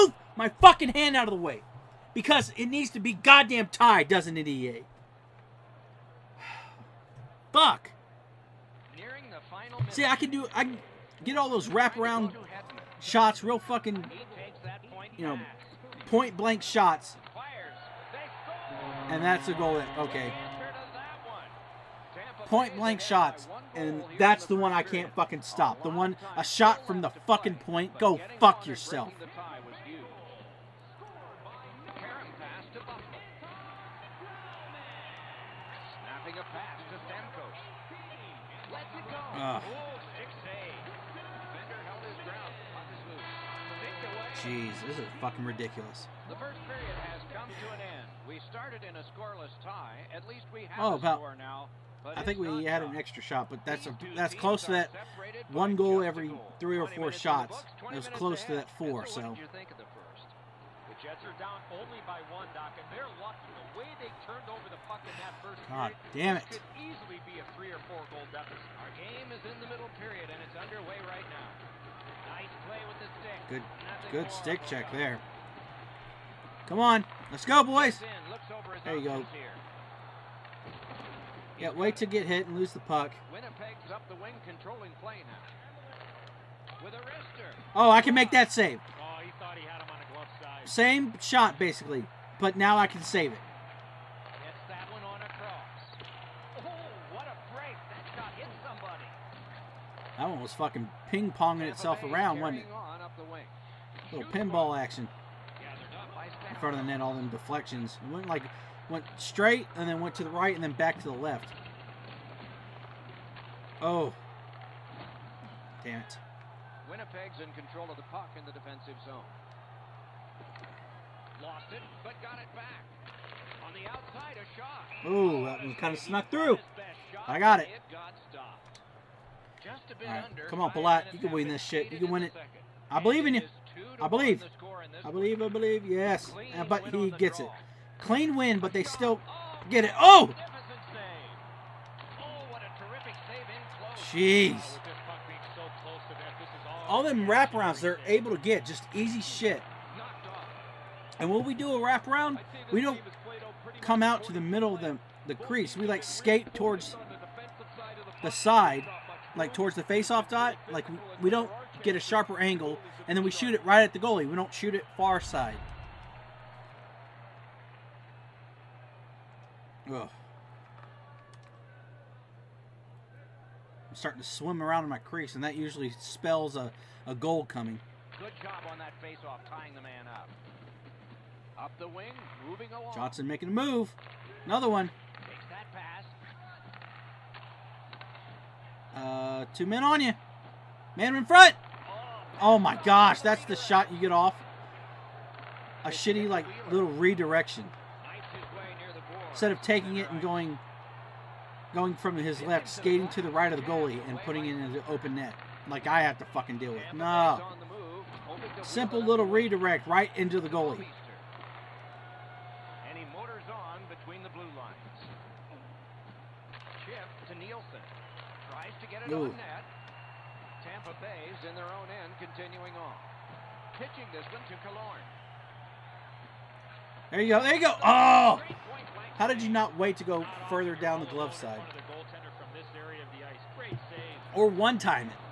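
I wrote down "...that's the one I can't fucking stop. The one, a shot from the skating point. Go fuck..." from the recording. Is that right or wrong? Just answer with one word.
wrong.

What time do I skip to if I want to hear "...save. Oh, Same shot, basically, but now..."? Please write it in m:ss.
1:28.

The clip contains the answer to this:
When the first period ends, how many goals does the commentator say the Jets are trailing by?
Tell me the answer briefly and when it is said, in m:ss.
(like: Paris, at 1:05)
1, at 1:00.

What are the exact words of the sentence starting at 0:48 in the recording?
We started in a scoreless tie.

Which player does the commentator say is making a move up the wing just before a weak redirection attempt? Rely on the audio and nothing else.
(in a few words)
Johnson.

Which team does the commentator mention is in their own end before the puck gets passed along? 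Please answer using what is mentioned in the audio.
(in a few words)
Tampa Bay.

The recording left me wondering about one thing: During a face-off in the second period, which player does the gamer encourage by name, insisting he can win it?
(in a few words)
Palat.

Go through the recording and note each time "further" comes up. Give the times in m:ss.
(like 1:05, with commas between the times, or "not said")
3:50.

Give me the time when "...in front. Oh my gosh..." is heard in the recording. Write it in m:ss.
3:11.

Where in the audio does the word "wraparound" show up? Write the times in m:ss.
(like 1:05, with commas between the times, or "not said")
0:11, 2:27, 2:31.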